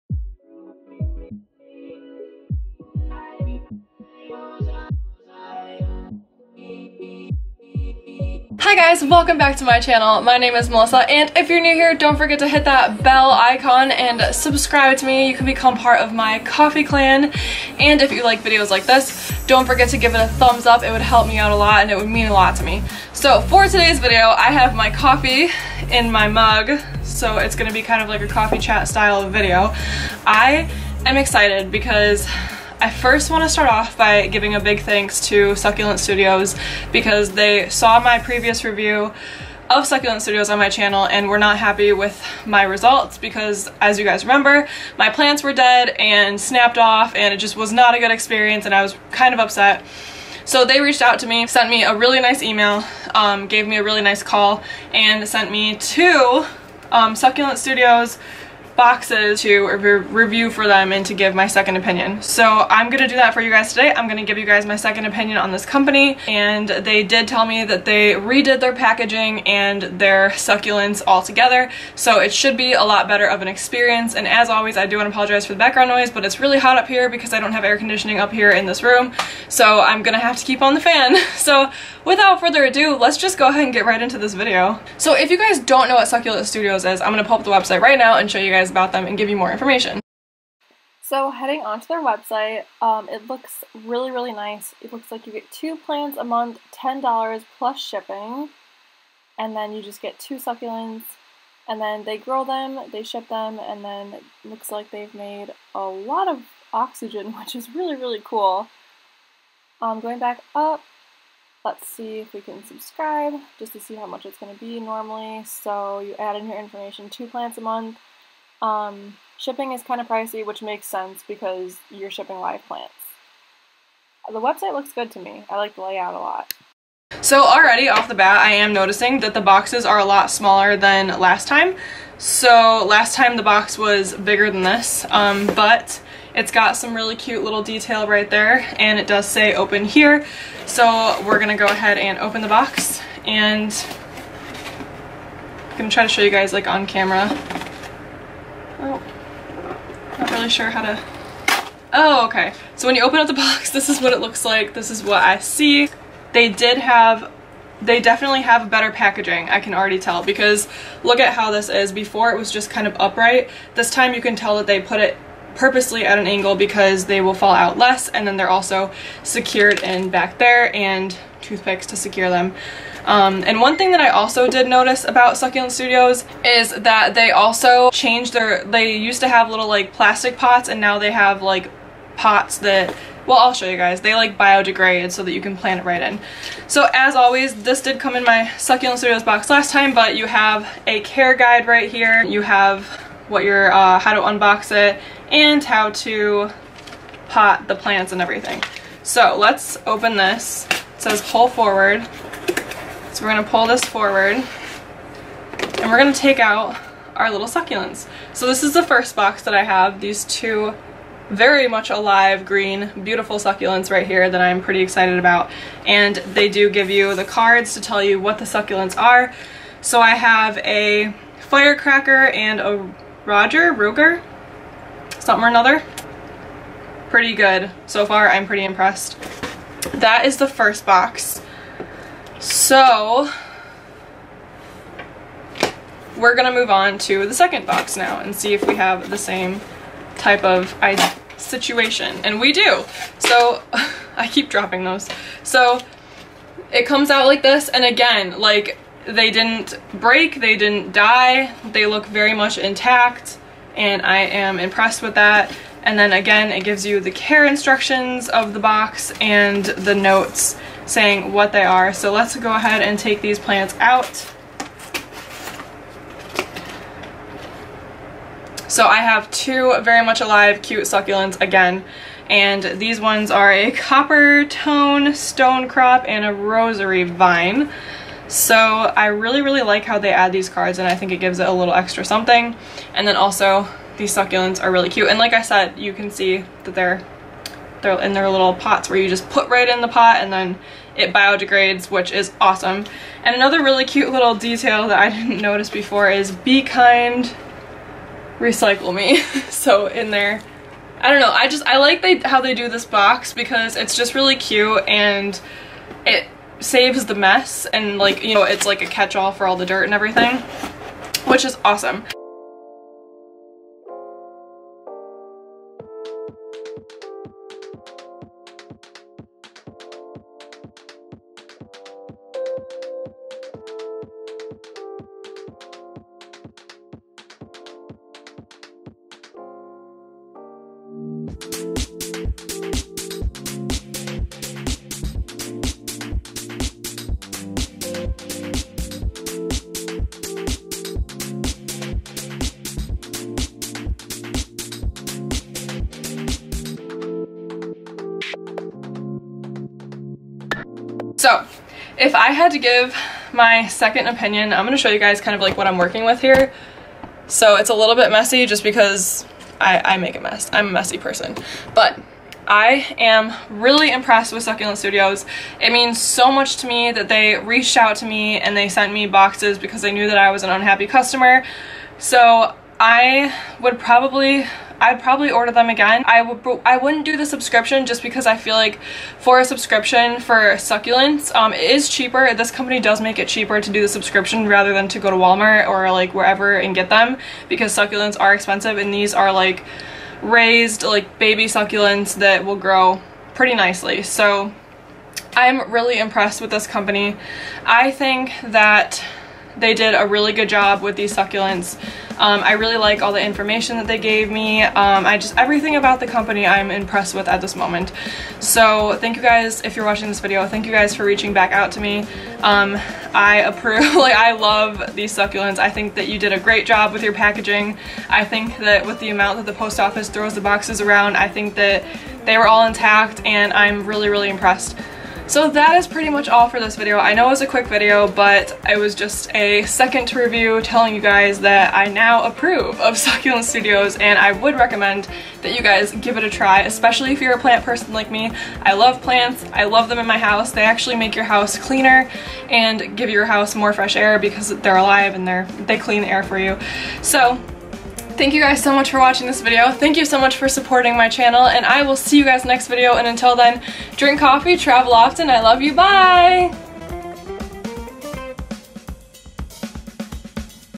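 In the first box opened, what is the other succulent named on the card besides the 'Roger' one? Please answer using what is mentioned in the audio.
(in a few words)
firecracker.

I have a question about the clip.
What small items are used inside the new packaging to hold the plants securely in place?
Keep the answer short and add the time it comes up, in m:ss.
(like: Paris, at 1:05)
toothpicks, at 2:51.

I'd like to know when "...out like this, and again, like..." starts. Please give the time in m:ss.
4:07.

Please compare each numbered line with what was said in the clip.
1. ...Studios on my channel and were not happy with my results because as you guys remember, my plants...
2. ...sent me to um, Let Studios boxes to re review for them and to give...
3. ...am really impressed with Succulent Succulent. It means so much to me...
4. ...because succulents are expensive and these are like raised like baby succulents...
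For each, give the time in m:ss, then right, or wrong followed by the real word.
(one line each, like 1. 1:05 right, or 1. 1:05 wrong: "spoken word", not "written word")
1. 0:40 right
2. 0:55 wrong: "Succulent", not "Let"
3. 6:02 wrong: "Studios", not "Succulent"
4. 6:27 right.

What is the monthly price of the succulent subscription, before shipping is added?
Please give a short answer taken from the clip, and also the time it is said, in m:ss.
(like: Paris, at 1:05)
$10, at 1:36.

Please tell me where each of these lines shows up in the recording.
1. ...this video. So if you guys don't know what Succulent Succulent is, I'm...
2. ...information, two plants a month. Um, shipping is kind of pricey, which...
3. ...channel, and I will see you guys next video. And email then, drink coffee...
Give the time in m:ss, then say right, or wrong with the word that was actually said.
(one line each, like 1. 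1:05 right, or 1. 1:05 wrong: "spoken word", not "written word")
1. 1:24 wrong: "Studios", not "Succulent"
2. 1:56 right
3. 7:31 wrong: "until", not "email".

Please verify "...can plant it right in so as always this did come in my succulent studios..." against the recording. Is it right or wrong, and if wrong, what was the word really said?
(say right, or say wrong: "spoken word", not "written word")
right.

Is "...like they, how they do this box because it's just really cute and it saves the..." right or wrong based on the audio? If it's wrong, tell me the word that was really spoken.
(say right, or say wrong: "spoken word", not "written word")
right.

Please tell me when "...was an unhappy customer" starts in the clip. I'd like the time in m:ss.
6:10.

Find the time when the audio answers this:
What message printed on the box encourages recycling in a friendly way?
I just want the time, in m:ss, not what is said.
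4:56.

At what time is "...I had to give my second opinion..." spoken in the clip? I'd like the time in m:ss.
5:52.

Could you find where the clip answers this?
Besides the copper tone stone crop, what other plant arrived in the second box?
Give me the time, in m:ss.
4:36.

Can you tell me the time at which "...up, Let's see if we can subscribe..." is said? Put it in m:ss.
1:50.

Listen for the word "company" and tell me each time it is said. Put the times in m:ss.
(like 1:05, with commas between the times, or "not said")
1:05, 6:22, 6:36, 6:46.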